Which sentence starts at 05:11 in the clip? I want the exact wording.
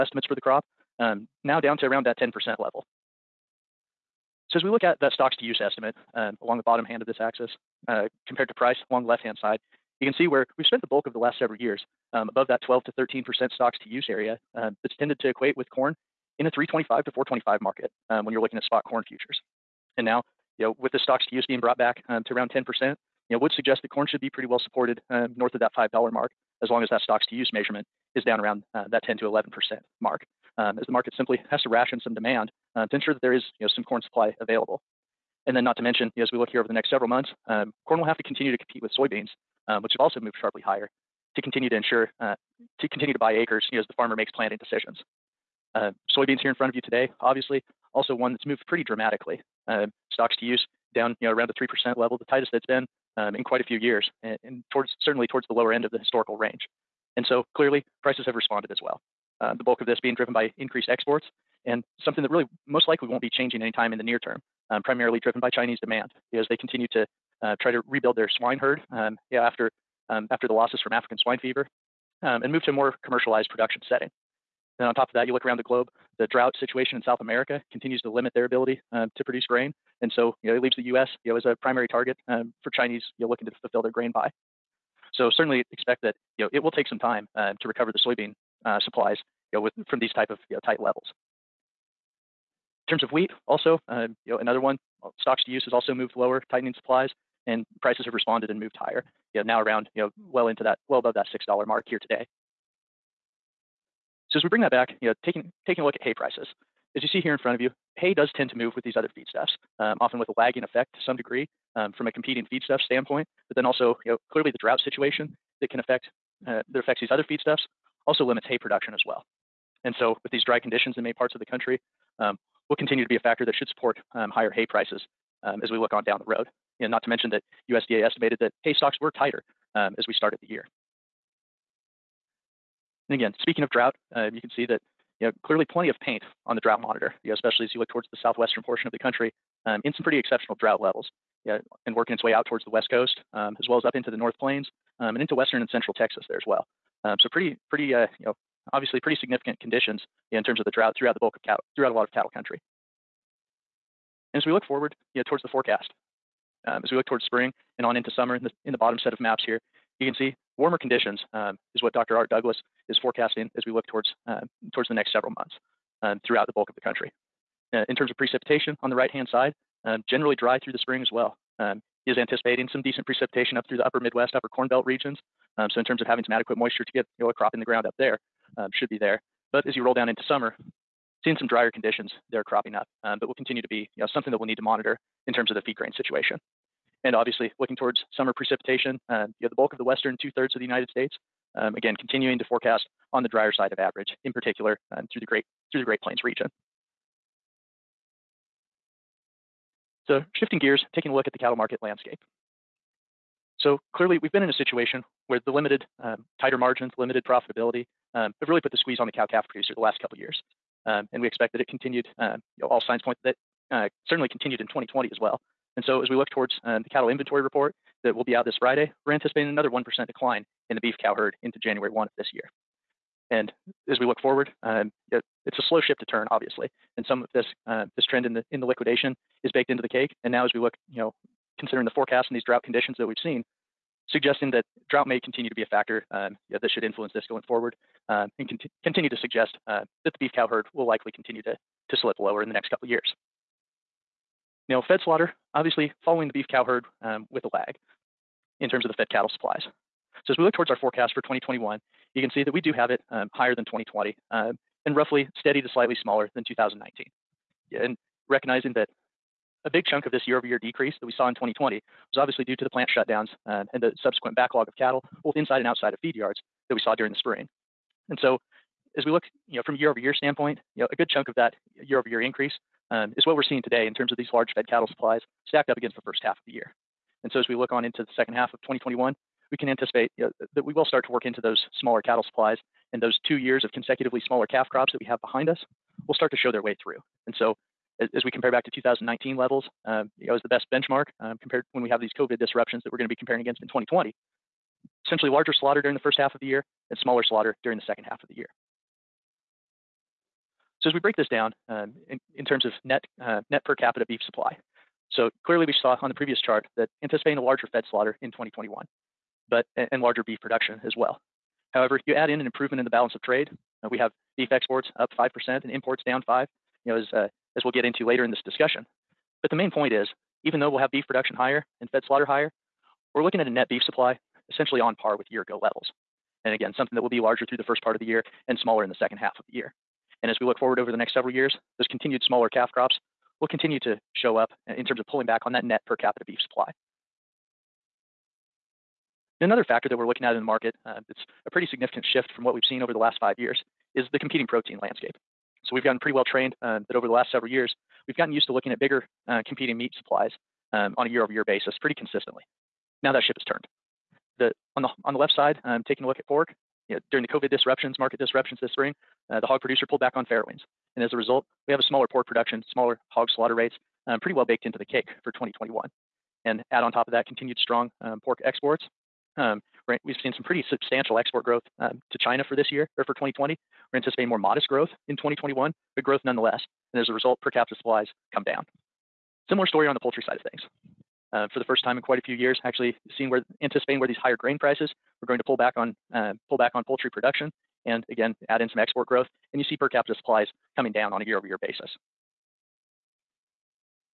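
However, you add in an improvement in the balance of trade.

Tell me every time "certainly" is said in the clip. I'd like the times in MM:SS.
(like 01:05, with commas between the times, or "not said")
00:55, 01:25, 03:34.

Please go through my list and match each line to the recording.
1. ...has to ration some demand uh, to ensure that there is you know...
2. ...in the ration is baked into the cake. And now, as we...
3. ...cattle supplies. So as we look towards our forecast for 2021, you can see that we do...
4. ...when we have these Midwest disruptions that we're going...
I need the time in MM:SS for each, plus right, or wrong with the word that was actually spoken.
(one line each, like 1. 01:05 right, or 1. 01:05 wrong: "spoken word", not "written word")
1. 00:31 right
2. 03:48 wrong: "liquidation", not "ration"
3. 04:09 right
4. 04:51 wrong: "COVID", not "Midwest".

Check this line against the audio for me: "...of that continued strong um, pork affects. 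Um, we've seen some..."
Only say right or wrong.
wrong.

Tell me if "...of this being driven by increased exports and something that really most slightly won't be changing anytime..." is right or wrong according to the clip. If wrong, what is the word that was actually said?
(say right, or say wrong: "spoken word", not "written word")
wrong: "likely", not "slightly".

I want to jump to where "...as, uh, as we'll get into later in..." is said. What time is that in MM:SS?
05:17.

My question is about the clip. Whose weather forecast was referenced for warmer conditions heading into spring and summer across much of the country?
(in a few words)
Dr. Art Douglas.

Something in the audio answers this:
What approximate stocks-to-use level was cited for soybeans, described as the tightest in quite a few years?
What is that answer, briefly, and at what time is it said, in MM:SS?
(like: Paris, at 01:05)
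3 percent, at 00:51.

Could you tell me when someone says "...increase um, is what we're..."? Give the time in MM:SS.
04:32.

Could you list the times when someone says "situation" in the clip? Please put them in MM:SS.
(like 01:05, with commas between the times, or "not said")
01:16, 01:54, 03:05, 03:24.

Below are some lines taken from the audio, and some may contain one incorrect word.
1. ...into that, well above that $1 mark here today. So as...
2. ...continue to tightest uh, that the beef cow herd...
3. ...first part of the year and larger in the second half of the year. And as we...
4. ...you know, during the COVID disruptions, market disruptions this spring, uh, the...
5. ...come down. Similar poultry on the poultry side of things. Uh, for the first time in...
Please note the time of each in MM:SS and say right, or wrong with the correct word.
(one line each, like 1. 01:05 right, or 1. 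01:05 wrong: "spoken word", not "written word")
1. 01:40 wrong: "6", not "1"
2. 03:58 wrong: "suggest", not "tightest"
3. 05:27 wrong: "smaller", not "larger"
4. 05:56 right
5. 06:18 wrong: "story", not "poultry".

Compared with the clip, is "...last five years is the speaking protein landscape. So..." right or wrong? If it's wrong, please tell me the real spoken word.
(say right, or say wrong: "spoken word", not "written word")
wrong: "competing", not "speaking".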